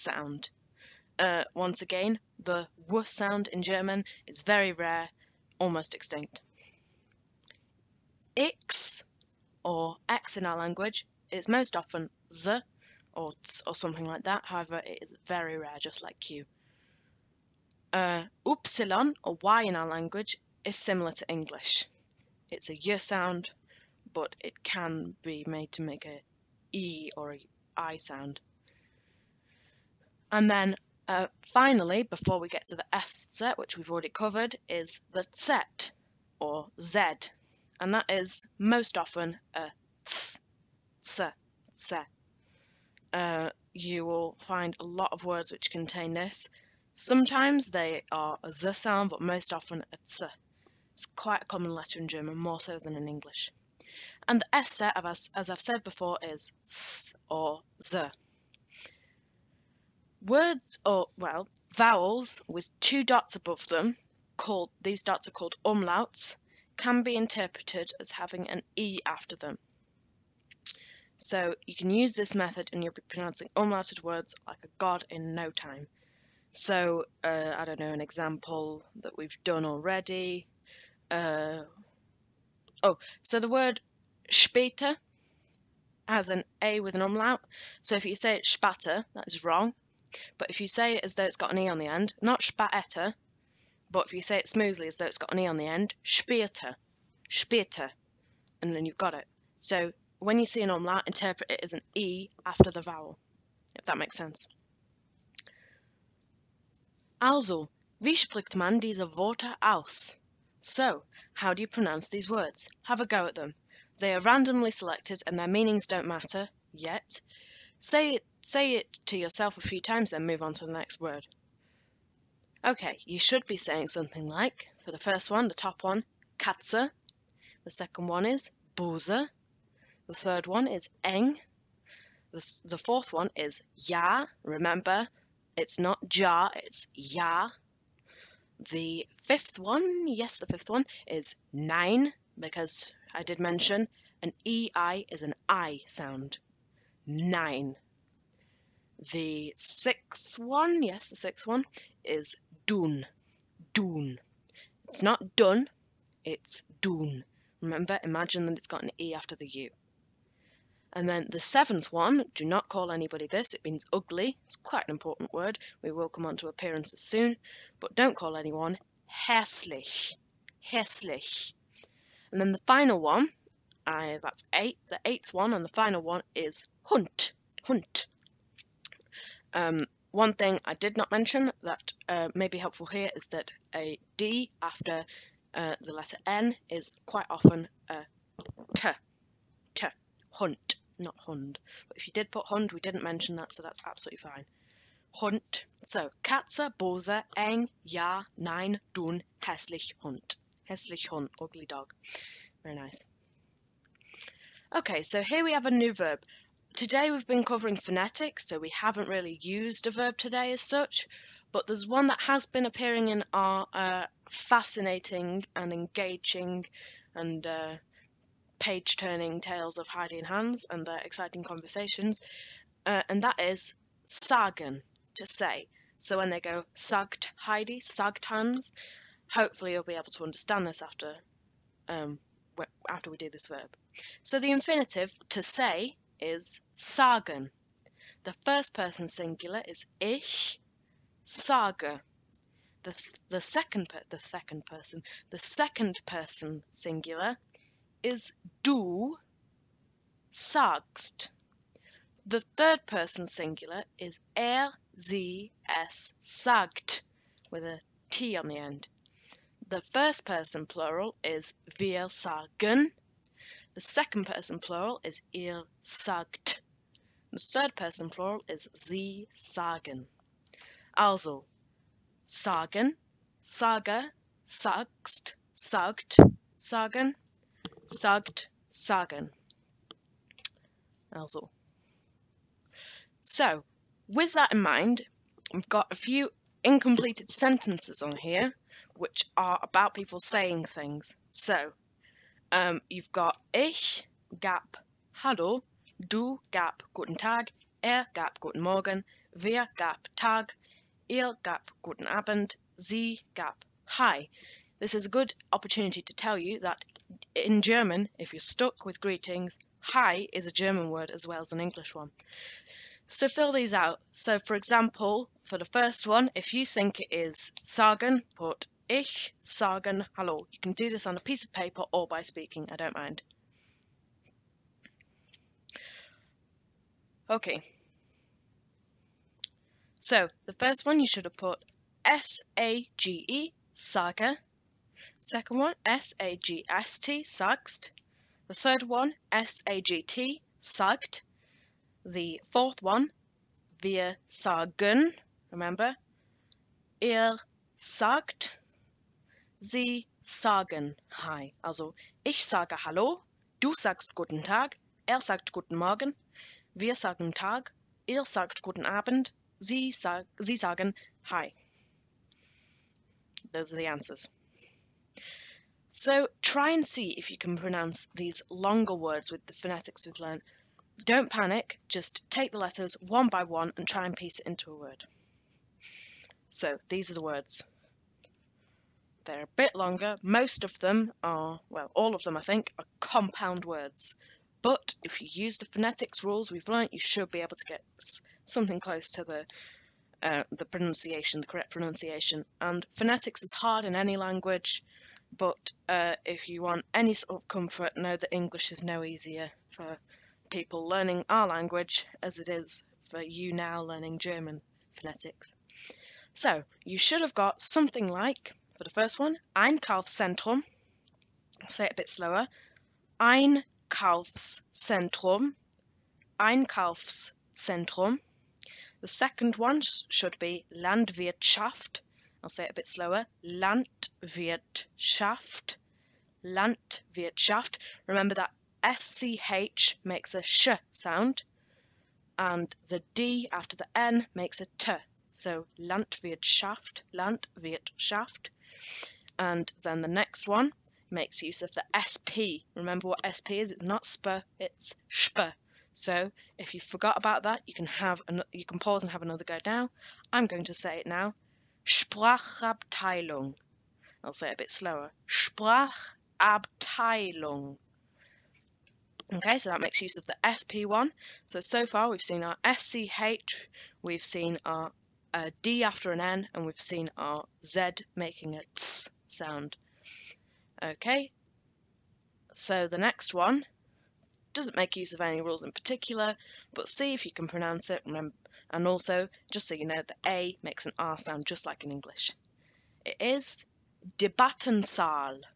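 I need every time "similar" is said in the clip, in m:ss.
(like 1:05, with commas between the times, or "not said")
0:20.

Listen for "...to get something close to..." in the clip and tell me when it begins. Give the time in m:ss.
6:27.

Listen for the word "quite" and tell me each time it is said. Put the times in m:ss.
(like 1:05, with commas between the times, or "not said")
0:51, 2:44, 3:07.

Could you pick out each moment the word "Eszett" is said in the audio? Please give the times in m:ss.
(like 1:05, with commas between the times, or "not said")
0:32, 0:54.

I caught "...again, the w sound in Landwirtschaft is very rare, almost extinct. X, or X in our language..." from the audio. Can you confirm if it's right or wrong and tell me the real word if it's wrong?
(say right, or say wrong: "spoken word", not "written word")
wrong: "German", not "Landwirtschaft".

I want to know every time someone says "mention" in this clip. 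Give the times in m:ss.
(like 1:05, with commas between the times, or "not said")
2:23, 3:01, 3:13.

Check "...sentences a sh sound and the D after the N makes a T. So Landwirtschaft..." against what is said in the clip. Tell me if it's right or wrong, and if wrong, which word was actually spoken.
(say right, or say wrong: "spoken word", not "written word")
wrong: "makes", not "sentences".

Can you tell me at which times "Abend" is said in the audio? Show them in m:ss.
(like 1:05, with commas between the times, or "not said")
5:02, 5:58.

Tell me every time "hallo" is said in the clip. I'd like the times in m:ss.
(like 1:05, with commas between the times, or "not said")
4:55, 5:20, 5:52.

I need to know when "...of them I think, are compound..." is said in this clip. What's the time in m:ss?
6:22.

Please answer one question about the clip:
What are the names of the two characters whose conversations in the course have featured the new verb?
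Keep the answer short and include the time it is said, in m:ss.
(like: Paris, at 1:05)
Heidi and Hans, at 3:39.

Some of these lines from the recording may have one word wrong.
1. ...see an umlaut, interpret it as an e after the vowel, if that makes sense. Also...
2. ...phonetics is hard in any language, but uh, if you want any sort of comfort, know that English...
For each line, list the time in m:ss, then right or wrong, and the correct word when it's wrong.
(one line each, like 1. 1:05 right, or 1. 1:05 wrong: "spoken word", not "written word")
1. 1:40 right
2. 6:32 right.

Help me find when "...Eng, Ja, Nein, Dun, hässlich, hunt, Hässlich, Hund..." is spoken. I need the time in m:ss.
3:17.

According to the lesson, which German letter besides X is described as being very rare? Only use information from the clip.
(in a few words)
Q.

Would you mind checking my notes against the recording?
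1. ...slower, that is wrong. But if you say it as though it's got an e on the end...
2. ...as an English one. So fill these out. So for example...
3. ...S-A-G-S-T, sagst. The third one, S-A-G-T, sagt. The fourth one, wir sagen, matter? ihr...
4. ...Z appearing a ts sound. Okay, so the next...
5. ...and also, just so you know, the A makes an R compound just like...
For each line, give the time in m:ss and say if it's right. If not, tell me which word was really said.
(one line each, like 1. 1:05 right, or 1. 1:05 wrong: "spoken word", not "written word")
1. 1:28 wrong: "spatter", not "slower"
2. 5:11 right
3. 5:35 wrong: "remember", not "matter"
4. 7:47 wrong: "making", not "appearing"
5. 7:58 wrong: "sound", not "compound".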